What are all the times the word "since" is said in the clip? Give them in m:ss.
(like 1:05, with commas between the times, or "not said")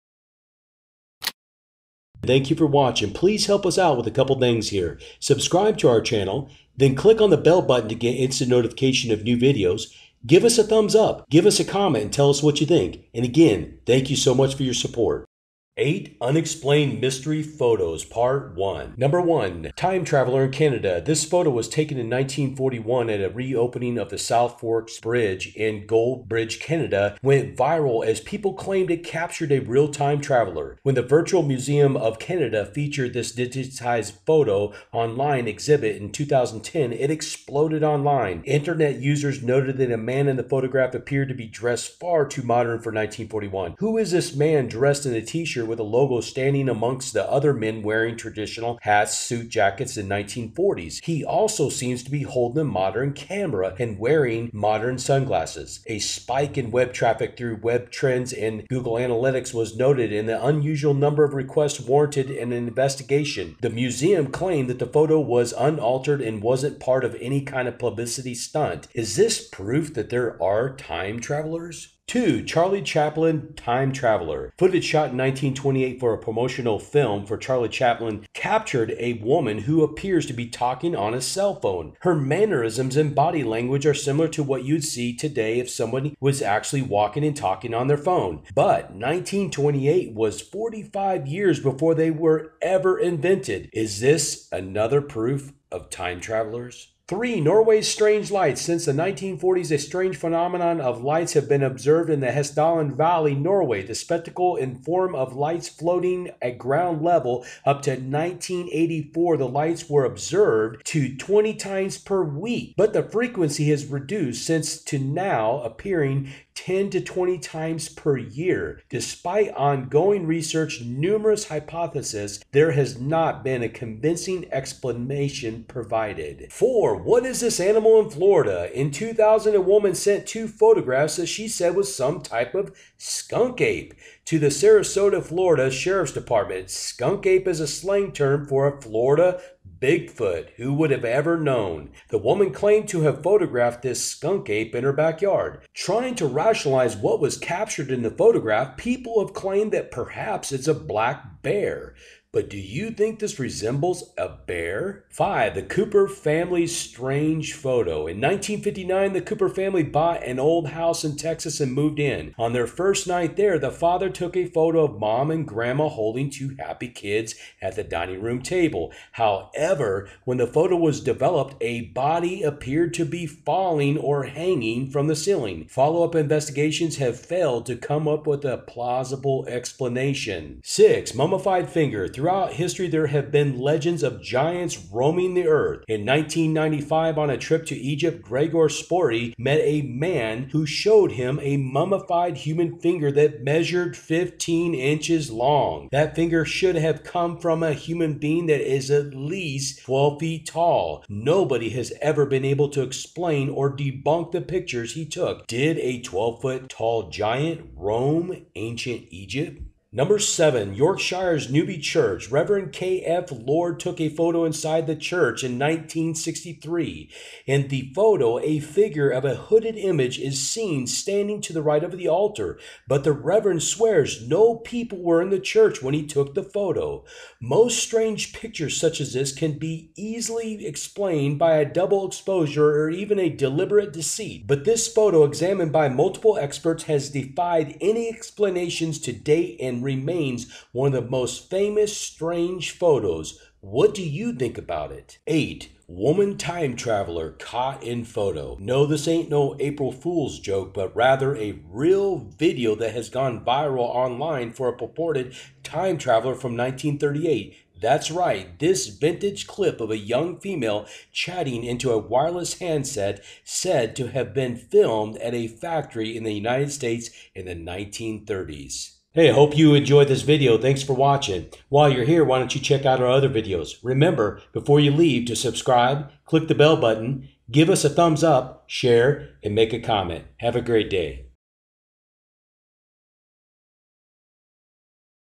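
1:38, 1:54.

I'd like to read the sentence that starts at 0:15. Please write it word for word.
8 Unexplained Mystery Photos Part 1 Number 1 Time Traveler in Canada.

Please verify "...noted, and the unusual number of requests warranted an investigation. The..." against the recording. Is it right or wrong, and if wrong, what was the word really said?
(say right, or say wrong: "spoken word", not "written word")
right.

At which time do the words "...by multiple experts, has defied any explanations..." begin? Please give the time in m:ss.
3:55.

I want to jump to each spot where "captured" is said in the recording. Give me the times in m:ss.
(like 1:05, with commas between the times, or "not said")
0:29, 1:18, 2:27.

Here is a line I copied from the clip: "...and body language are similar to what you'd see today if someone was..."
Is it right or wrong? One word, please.
right.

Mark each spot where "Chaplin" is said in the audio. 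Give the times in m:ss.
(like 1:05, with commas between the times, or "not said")
1:12, 1:17.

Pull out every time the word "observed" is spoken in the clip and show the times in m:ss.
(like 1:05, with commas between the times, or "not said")
1:41, 1:50.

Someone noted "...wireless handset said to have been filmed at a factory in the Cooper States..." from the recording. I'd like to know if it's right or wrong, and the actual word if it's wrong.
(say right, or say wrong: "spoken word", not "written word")
wrong: "United", not "Cooper".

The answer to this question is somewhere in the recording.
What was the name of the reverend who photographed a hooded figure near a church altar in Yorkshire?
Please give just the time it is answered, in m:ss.
3:32.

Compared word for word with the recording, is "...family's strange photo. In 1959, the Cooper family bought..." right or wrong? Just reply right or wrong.
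right.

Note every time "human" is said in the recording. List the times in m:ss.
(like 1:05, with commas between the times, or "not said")
3:12, 3:17.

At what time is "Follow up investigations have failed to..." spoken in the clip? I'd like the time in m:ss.
2:55.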